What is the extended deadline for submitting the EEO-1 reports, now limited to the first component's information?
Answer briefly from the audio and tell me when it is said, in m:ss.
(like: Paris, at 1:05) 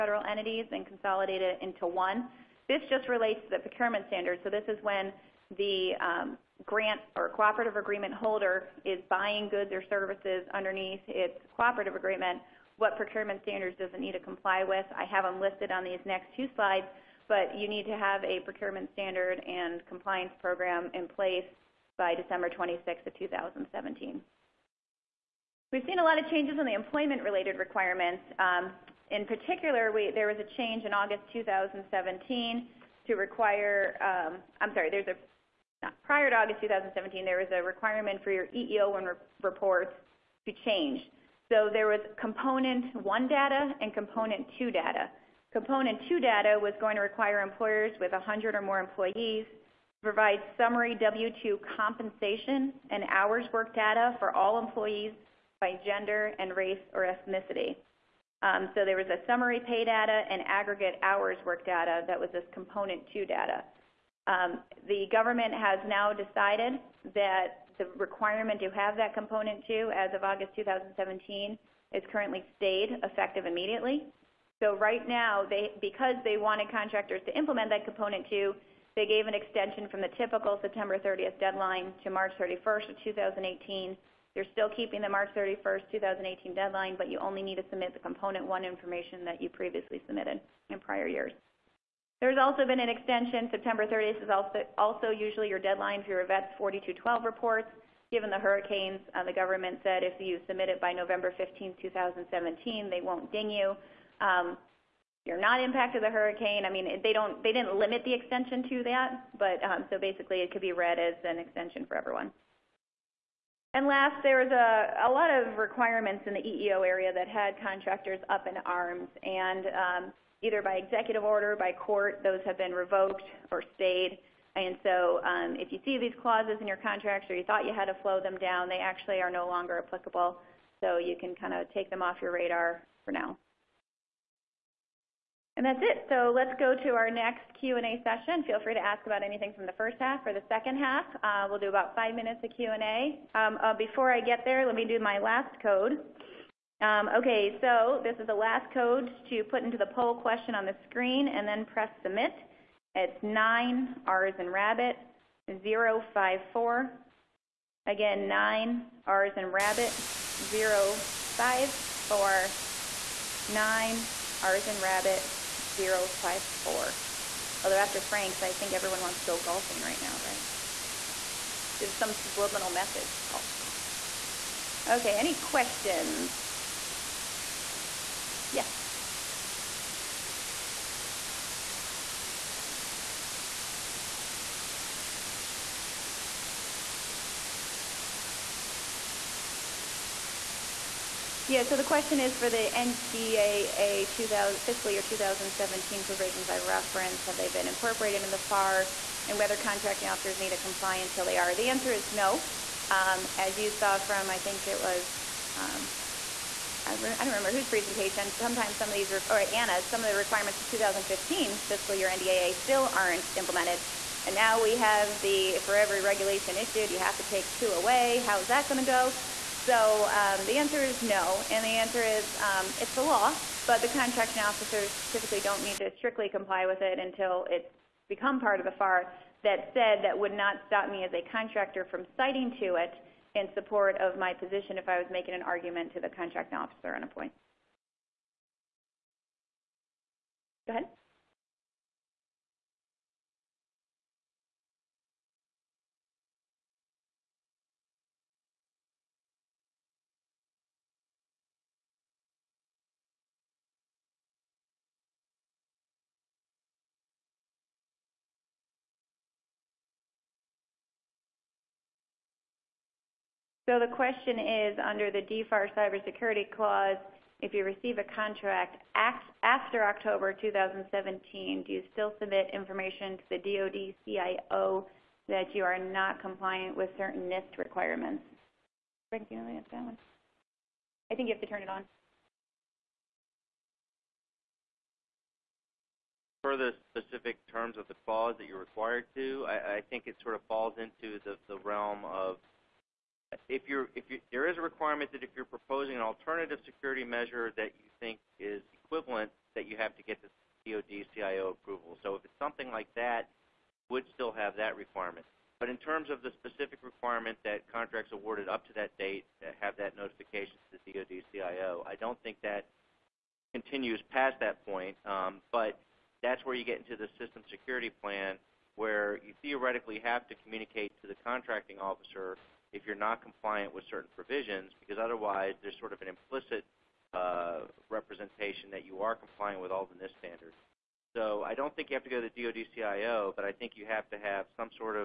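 March 31, 2018, at 1:22.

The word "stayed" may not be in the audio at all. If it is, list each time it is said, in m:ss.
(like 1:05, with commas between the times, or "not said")
1:12, 2:03.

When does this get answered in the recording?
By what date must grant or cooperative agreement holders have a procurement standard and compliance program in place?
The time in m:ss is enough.
0:22.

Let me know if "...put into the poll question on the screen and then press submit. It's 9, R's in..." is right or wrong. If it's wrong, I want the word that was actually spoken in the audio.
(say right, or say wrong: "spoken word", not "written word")
right.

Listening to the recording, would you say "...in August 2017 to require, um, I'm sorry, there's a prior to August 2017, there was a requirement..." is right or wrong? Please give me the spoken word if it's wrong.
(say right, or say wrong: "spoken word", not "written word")
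right.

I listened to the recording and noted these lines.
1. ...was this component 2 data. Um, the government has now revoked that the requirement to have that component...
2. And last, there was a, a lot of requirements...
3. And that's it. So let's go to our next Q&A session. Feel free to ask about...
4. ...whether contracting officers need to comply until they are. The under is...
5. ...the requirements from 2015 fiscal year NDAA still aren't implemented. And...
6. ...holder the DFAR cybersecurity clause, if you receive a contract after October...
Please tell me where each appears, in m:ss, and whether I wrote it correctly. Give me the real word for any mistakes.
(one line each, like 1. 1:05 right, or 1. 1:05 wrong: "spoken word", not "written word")
1. 1:02 wrong: "decided", not "revoked"
2. 1:53 right
3. 2:15 right
4. 3:19 wrong: "answer", not "under"
5. 3:30 right
6. 4:24 wrong: "under", not "holder".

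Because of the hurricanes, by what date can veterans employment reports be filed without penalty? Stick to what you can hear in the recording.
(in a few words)
November 15, 2017.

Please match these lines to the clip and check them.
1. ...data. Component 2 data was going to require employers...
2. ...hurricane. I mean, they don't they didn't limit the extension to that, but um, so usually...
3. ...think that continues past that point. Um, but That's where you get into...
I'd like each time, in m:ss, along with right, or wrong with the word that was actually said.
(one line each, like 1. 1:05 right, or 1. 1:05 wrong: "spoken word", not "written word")
1. 0:44 right
2. 1:46 wrong: "basically", not "usually"
3. 5:12 right.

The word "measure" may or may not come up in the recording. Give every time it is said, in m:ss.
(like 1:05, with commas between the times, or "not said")
4:57.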